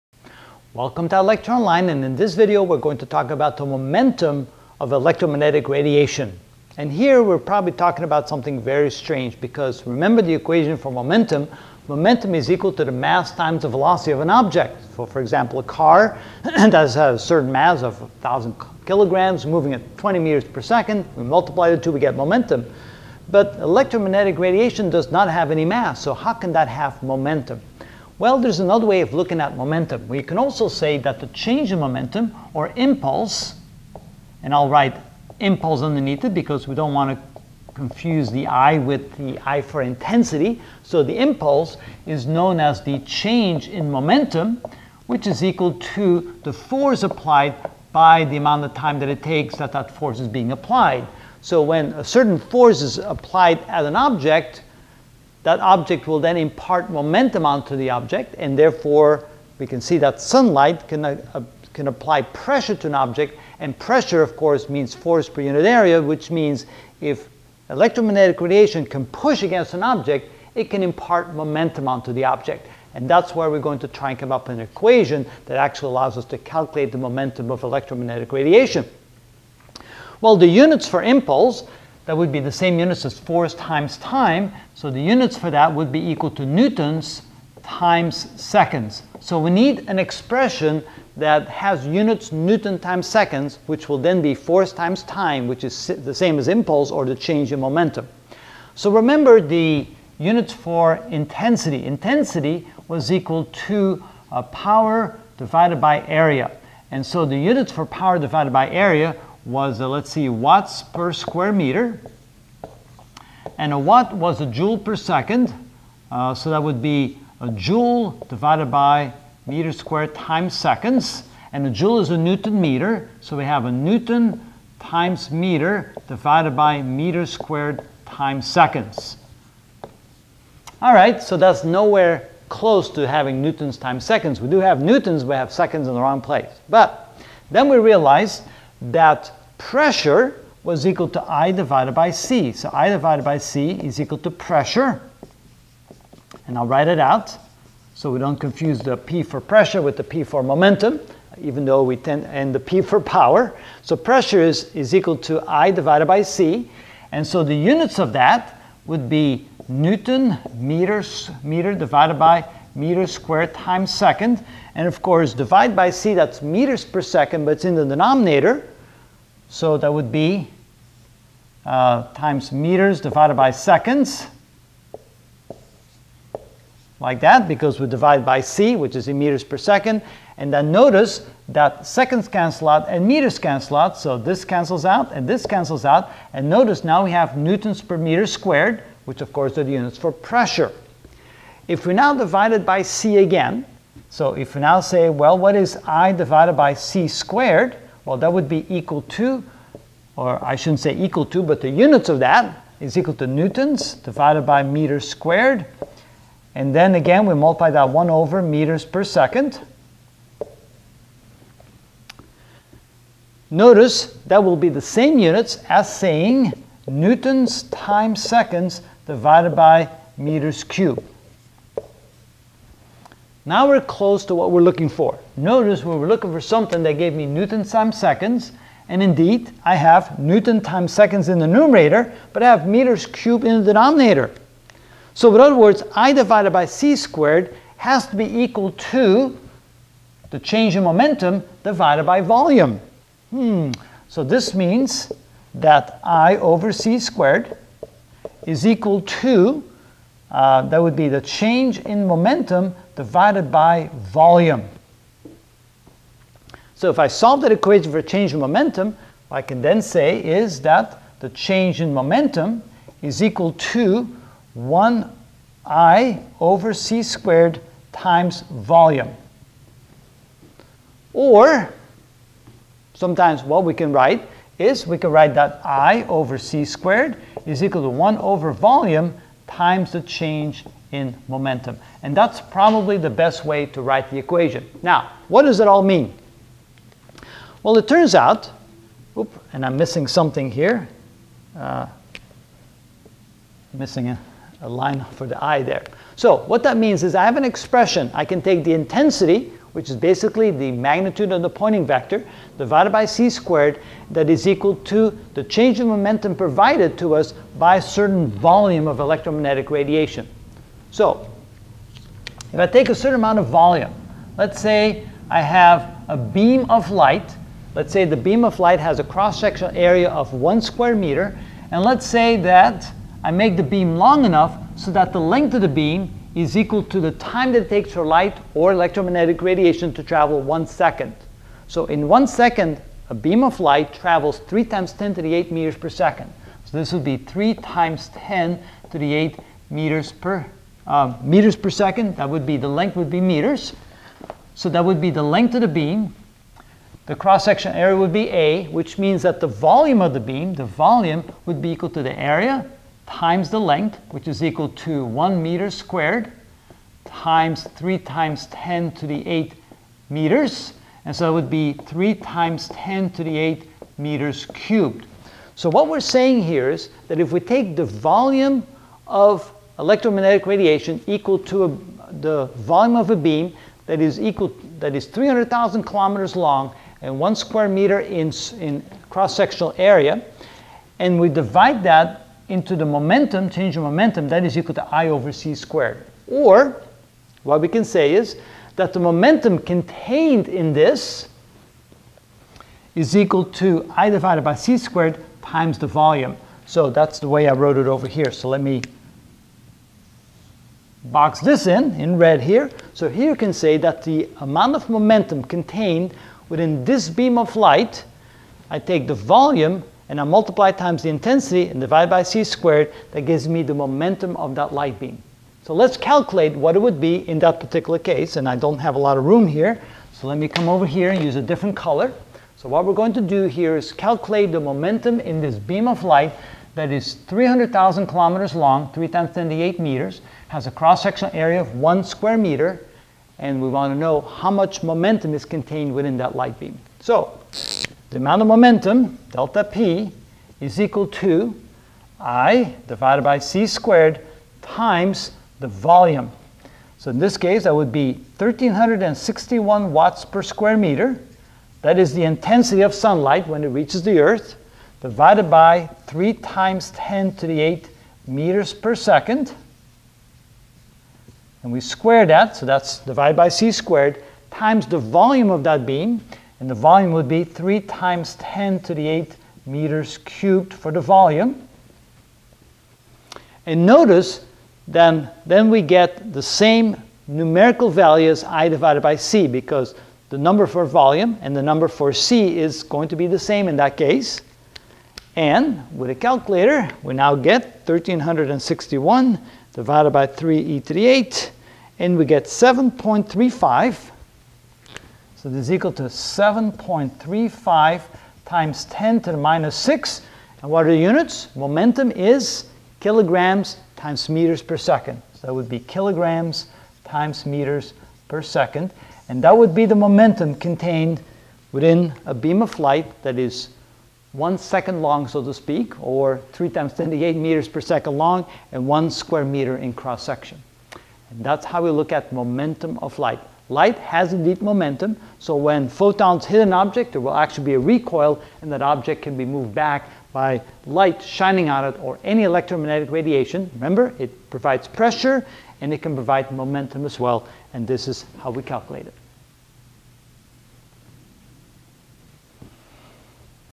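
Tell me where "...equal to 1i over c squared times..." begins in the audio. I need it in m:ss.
4:23.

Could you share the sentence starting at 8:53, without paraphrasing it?
Remember, it provides pressure and it can provide momentum as well, and this is how we calculate it.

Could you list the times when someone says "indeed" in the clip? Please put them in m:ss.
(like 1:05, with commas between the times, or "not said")
3:49, 8:44.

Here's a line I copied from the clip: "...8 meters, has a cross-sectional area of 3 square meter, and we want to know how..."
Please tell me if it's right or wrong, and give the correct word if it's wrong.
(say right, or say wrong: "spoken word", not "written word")
wrong: "1", not "3".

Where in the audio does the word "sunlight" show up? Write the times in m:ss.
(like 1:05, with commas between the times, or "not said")
1:00, 7:32.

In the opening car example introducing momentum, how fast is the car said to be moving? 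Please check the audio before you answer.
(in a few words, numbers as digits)
20 meters per second.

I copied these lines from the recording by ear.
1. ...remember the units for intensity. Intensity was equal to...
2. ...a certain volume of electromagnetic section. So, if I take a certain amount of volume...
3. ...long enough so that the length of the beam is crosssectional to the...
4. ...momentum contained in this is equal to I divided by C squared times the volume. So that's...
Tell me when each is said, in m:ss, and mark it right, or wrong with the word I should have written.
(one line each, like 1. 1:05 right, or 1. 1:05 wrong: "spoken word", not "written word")
1. 1:38 right
2. 5:07 wrong: "radiation", not "section"
3. 5:23 wrong: "equal", not "crosssectional"
4. 6:28 right.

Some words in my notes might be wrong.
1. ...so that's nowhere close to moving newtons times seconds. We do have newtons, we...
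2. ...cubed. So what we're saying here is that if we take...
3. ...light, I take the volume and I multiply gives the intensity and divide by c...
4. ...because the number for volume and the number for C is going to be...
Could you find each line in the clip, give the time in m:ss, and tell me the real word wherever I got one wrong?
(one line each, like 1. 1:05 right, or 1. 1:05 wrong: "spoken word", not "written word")
1. 2:11 wrong: "having", not "moving"
2. 6:04 right
3. 6:47 wrong: "times", not "gives"
4. 7:59 right.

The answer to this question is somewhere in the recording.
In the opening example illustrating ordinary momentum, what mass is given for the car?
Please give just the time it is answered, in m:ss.
0:18.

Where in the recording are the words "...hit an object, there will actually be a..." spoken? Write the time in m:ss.
8:46.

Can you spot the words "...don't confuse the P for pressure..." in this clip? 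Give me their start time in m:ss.
2:28.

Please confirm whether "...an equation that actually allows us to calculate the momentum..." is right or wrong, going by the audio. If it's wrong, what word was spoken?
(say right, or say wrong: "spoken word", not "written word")
right.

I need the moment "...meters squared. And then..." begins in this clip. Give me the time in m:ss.
3:24.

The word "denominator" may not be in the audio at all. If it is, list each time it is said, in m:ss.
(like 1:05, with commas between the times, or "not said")
2:47, 3:53.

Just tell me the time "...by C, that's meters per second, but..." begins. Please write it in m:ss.
2:45.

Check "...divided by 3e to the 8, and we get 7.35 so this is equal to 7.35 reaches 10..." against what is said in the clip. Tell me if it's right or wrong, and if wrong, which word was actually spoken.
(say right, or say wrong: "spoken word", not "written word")
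wrong: "times", not "reaches".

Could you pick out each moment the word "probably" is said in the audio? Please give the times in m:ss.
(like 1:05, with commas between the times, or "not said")
0:07, 4:42.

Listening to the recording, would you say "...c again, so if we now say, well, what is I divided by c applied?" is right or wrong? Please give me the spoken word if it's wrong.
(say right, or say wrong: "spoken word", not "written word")
wrong: "squared", not "applied".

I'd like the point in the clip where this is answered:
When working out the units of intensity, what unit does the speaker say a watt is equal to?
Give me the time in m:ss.
1:54.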